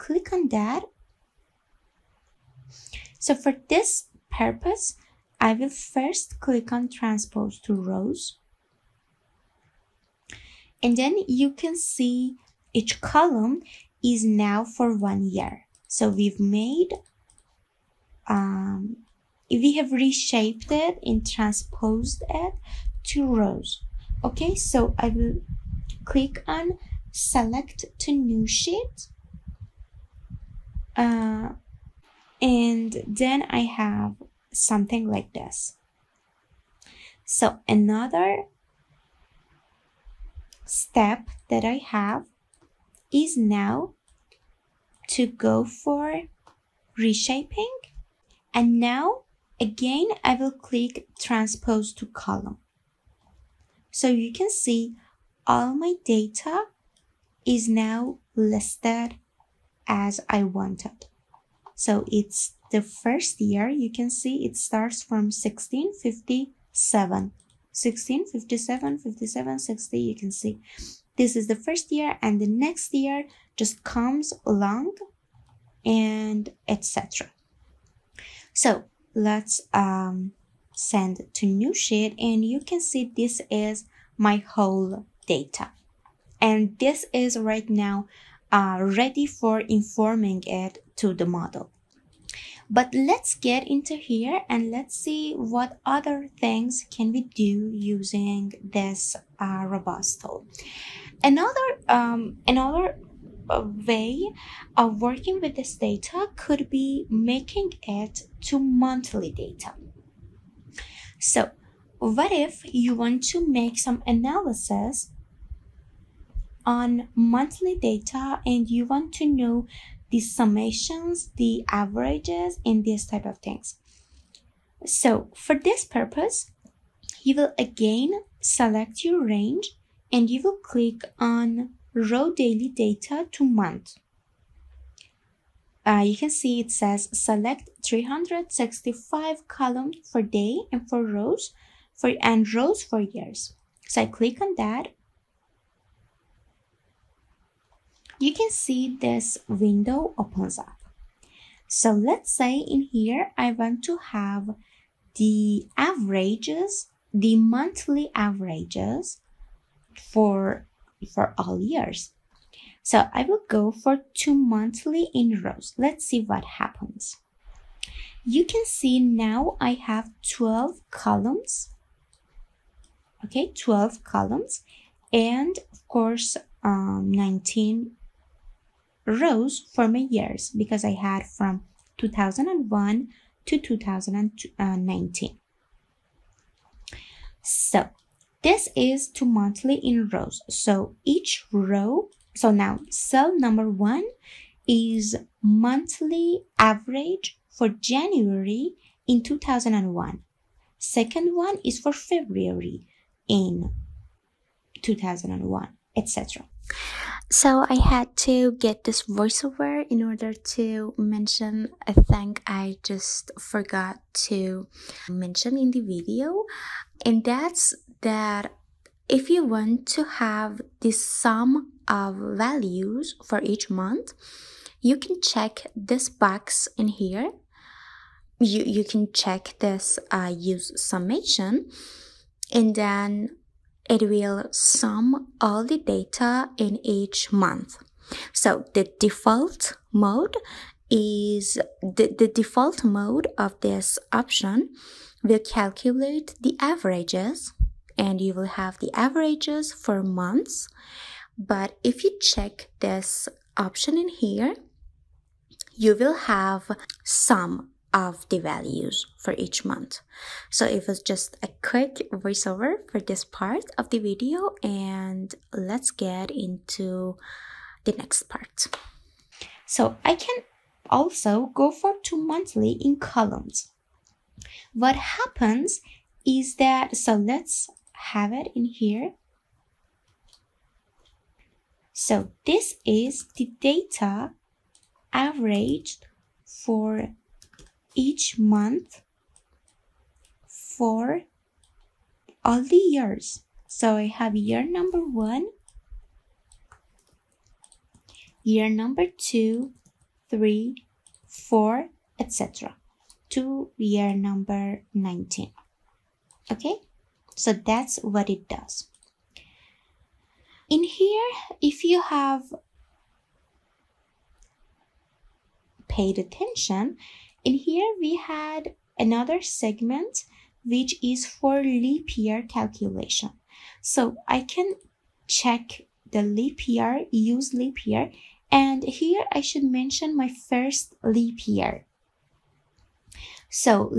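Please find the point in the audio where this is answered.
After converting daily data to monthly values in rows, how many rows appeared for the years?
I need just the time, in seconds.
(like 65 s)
177 s.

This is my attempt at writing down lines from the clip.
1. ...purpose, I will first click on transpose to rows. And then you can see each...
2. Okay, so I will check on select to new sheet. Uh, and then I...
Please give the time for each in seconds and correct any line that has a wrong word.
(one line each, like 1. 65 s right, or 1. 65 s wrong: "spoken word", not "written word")
1. 4 s right
2. 24 s wrong: "click", not "check".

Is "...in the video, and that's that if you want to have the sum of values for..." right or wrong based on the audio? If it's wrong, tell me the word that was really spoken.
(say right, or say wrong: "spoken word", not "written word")
right.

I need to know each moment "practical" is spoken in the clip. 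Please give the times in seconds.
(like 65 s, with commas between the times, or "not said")
not said.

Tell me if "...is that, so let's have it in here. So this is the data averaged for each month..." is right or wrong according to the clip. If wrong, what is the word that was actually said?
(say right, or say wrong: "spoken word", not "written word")
right.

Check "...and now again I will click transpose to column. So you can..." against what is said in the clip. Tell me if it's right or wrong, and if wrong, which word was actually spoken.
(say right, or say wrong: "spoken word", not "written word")
right.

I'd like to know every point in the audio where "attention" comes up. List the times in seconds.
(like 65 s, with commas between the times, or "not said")
316 s.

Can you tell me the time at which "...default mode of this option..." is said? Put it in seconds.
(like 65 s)
242 s.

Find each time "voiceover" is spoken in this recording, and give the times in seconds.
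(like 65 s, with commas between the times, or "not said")
209 s, 262 s.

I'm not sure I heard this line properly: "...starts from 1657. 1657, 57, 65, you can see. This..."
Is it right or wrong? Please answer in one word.
wrong.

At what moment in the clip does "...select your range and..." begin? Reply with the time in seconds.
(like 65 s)
128 s.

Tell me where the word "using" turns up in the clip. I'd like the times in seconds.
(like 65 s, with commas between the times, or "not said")
97 s.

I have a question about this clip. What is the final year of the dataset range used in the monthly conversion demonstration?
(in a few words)
2019.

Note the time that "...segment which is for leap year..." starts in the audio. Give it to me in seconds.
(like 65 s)
319 s.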